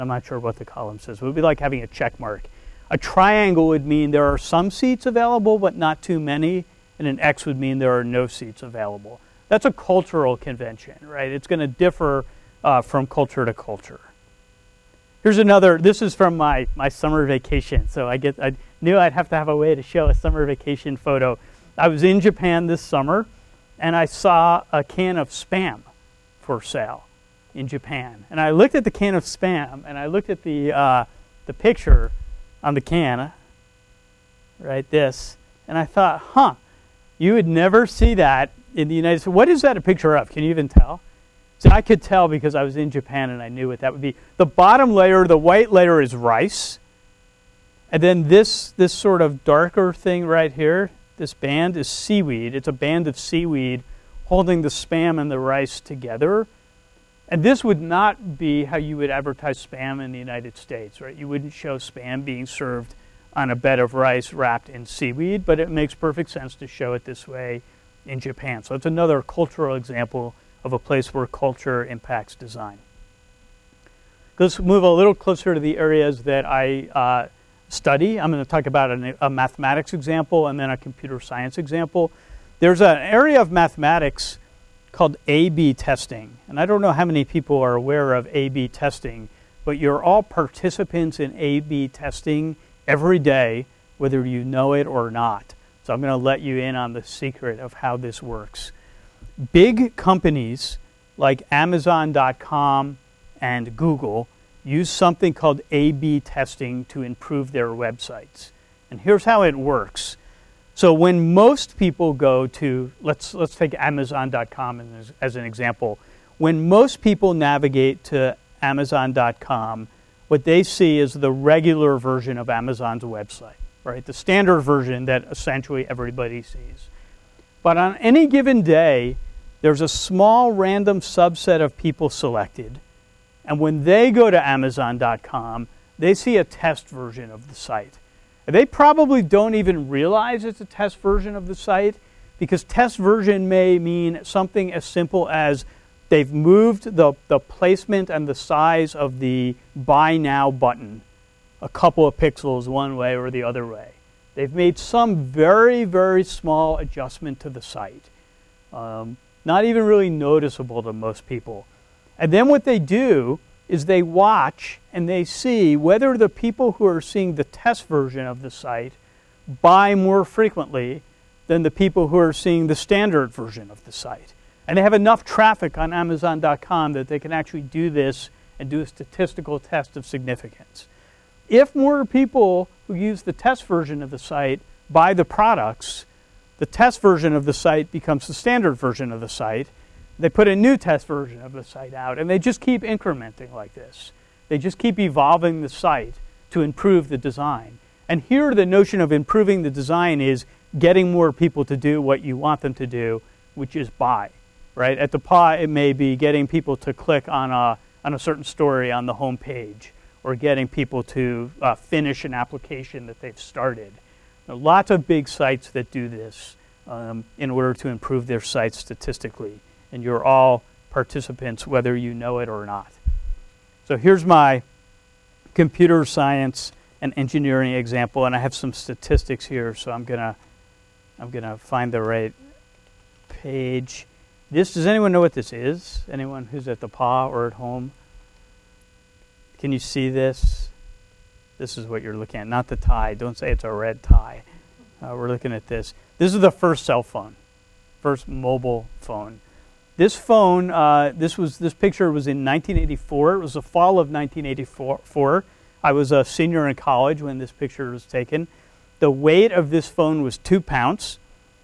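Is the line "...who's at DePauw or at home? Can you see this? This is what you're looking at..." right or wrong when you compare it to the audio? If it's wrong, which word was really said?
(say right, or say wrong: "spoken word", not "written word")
right.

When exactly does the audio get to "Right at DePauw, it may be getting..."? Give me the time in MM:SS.
03:24.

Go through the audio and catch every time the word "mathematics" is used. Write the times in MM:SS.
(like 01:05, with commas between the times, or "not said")
01:19, 01:23.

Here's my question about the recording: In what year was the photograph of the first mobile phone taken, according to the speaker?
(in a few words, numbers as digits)
1984.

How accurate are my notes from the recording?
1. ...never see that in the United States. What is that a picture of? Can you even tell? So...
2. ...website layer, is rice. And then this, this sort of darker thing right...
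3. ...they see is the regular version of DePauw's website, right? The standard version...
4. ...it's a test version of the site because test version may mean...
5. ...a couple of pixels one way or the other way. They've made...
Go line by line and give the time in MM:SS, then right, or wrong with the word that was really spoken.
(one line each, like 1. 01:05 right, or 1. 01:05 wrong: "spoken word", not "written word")
1. 00:37 right
2. 00:45 wrong: "white", not "website"
3. 02:00 wrong: "Amazon", not "DePauw"
4. 02:20 right
5. 02:31 right.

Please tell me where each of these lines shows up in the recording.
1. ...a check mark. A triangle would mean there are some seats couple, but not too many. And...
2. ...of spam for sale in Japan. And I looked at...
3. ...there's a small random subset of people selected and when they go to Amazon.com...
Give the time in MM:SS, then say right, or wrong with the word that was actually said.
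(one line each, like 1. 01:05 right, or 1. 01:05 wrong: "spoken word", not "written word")
1. 00:01 wrong: "available", not "couple"
2. 00:25 right
3. 02:09 right.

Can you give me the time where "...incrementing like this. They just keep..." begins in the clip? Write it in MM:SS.
03:12.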